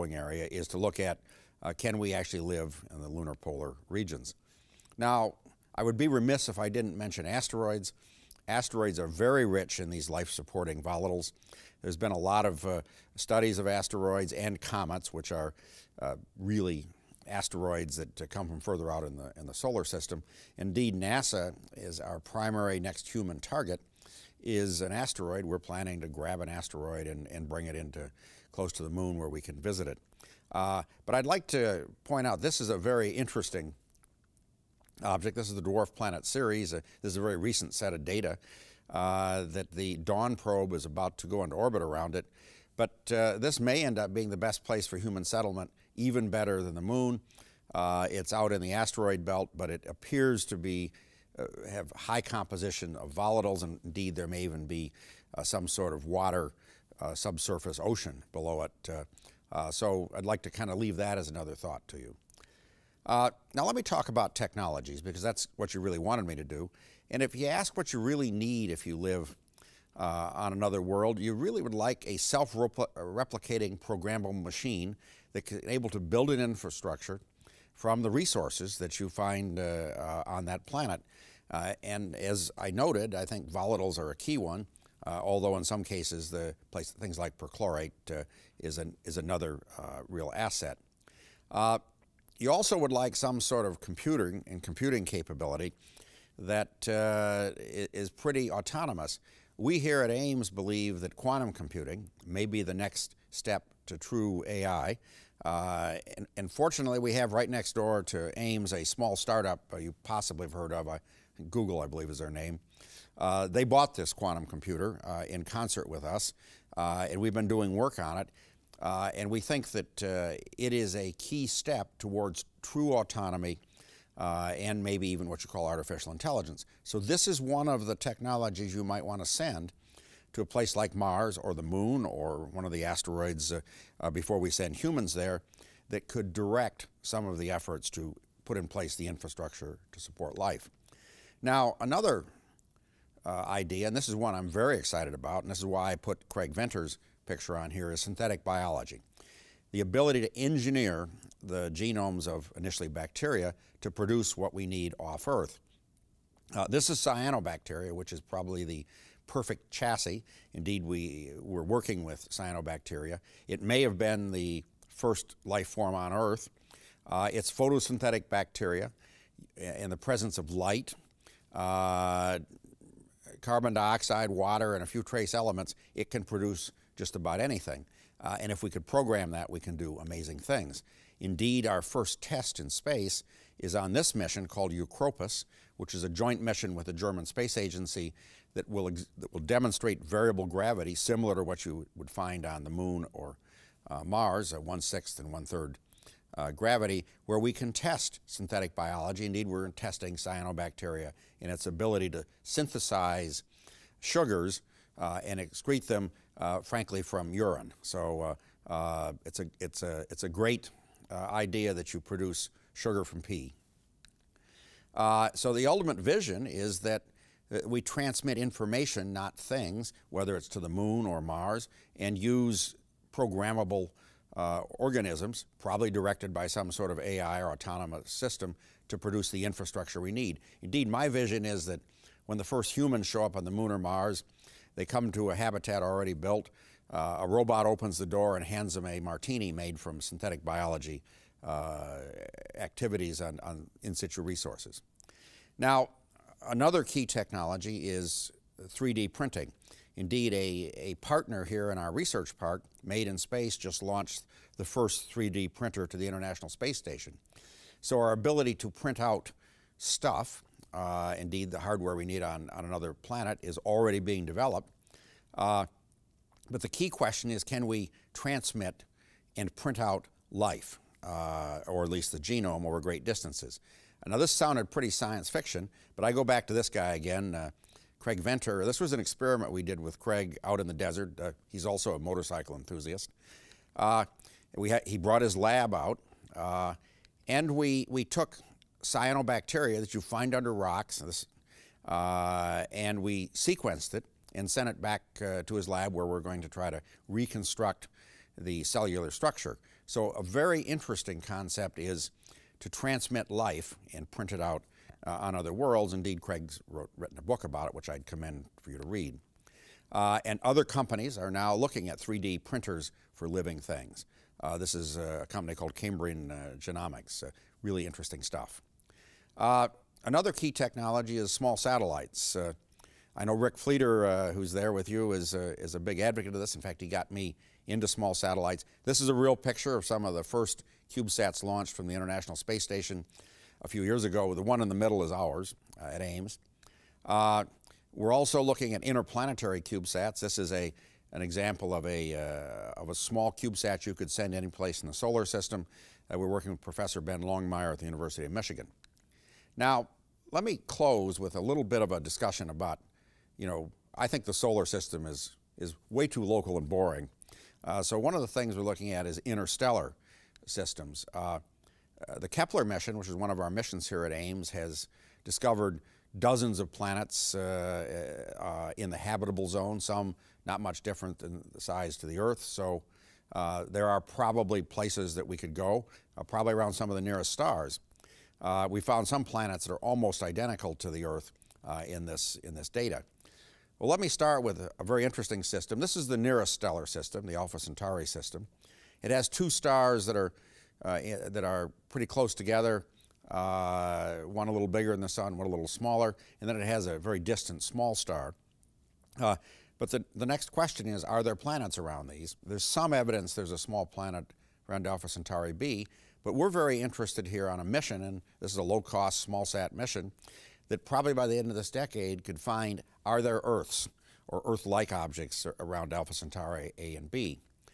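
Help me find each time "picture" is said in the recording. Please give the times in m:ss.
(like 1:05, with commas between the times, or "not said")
2:27, 5:29.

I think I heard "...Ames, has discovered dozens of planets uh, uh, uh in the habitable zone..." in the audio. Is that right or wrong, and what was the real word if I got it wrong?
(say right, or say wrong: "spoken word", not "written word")
right.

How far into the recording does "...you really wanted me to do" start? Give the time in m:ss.
1:05.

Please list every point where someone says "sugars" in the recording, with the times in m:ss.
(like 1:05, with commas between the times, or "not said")
3:23, 3:32.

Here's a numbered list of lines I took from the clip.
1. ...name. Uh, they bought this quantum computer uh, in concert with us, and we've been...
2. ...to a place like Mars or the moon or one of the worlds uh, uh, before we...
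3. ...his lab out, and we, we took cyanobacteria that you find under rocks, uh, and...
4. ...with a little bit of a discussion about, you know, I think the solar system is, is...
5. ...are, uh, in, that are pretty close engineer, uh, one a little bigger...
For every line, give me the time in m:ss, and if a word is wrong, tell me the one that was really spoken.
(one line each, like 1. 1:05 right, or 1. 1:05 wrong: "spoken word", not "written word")
1. 1:52 right
2. 2:10 wrong: "asteroids", not "worlds"
3. 4:45 right
4. 5:51 right
5. 6:30 wrong: "together", not "engineer".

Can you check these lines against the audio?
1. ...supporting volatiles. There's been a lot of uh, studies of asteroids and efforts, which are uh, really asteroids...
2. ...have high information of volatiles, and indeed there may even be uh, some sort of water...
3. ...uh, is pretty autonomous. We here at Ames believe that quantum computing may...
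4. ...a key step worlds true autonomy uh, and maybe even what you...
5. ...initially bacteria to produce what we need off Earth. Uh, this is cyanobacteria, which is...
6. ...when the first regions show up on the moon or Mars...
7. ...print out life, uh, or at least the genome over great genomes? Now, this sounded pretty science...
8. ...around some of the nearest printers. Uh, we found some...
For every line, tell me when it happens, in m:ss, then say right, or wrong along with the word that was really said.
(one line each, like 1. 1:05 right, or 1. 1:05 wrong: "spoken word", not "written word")
1. 0:10 wrong: "comets", not "efforts"
2. 0:51 wrong: "composition", not "information"
3. 1:36 right
4. 2:00 wrong: "towards", not "worlds"
5. 2:32 right
6. 3:52 wrong: "humans", not "regions"
7. 4:29 wrong: "distances", not "genomes"
8. 6:16 wrong: "stars", not "printers".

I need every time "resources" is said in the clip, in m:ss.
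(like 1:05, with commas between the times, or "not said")
1:18, 4:04.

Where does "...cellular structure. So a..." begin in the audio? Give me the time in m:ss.
4:58.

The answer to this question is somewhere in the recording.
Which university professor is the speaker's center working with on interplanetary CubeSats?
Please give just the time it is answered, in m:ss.
5:47.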